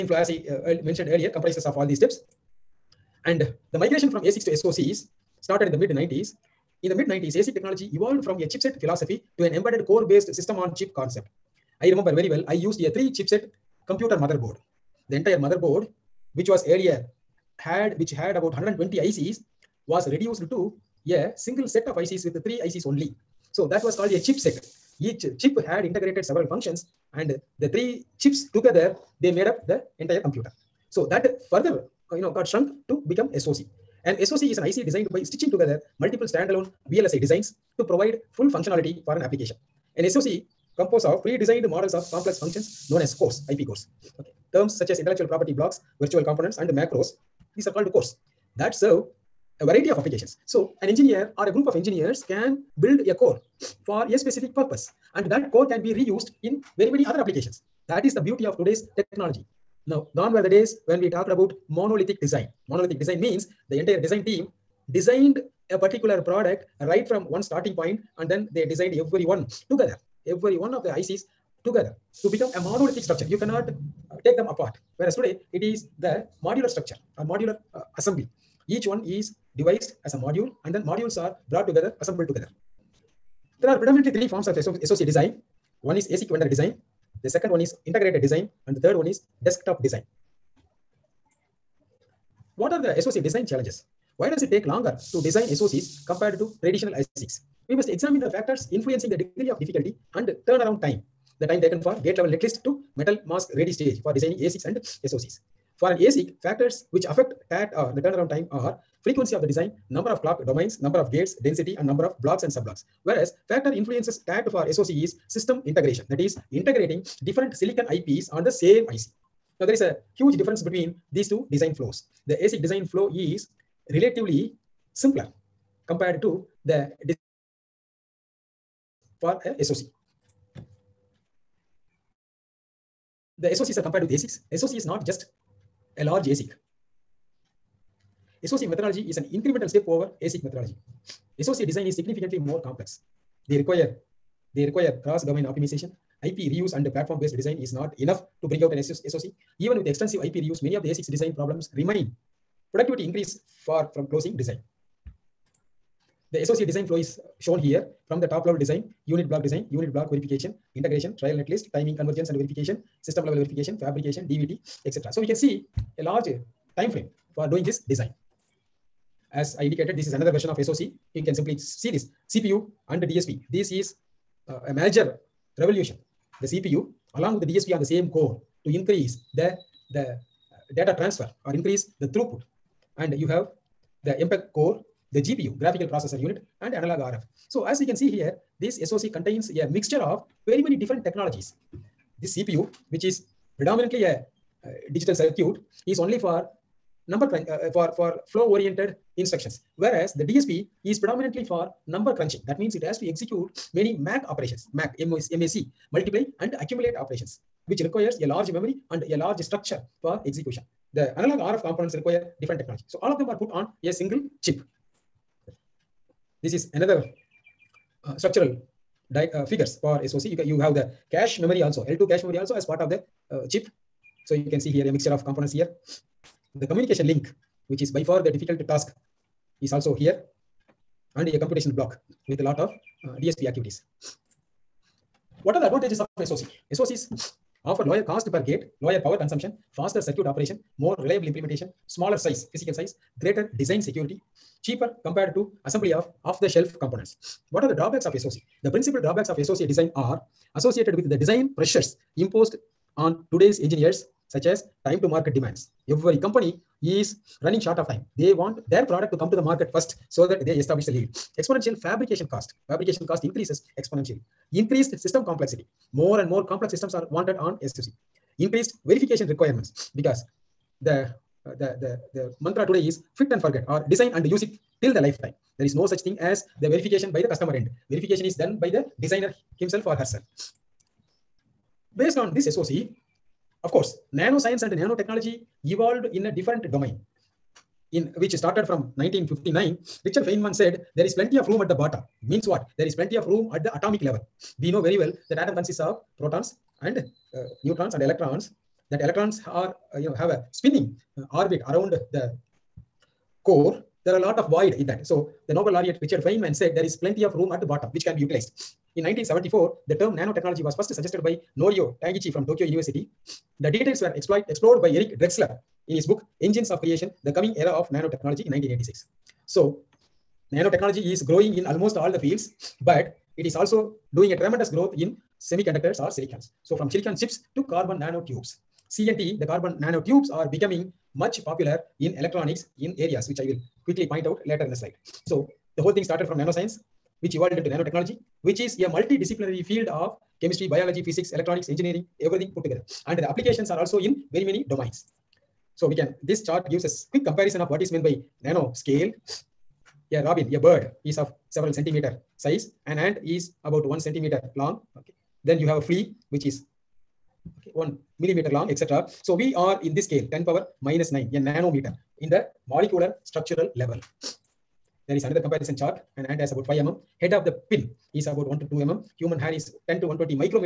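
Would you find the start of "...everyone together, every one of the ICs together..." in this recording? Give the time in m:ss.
1:08.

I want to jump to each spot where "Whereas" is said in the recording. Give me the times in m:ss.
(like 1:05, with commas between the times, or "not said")
1:14, 1:53, 3:19.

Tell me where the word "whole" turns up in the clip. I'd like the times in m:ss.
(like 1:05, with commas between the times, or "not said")
5:35.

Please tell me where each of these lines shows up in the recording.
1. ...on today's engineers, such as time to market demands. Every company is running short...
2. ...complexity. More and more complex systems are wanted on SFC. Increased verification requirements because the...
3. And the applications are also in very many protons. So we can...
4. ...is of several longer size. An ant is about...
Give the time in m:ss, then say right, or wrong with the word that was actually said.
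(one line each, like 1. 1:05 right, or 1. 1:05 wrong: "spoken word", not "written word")
1. 4:12 right
2. 4:25 right
3. 5:43 wrong: "domains", not "protons"
4. 5:51 wrong: "centimeter", not "longer".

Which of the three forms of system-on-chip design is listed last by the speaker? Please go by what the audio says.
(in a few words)
Desktop design.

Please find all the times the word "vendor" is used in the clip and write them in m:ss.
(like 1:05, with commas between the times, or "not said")
1:26.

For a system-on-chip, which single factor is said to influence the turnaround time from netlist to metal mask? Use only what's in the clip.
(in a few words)
System integration.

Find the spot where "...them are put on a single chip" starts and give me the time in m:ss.
3:33.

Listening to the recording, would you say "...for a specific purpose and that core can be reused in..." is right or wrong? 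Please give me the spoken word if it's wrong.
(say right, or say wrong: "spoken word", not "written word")
right.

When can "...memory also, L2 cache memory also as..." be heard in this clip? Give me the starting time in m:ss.
3:41.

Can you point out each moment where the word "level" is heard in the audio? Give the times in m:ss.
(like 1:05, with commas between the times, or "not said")
1:42, 2:38, 2:43, 4:54, 6:03.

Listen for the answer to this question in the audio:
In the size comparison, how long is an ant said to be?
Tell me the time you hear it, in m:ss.
6:06.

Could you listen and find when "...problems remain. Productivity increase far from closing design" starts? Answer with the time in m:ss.
2:31.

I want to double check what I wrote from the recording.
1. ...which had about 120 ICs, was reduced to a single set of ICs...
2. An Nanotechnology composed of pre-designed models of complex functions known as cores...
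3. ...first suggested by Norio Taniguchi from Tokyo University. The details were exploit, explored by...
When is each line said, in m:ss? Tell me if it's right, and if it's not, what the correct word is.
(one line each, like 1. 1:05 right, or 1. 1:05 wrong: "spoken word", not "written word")
1. 0:17 right
2. 0:39 wrong: "SOC", not "Nanotechnology"
3. 5:10 right.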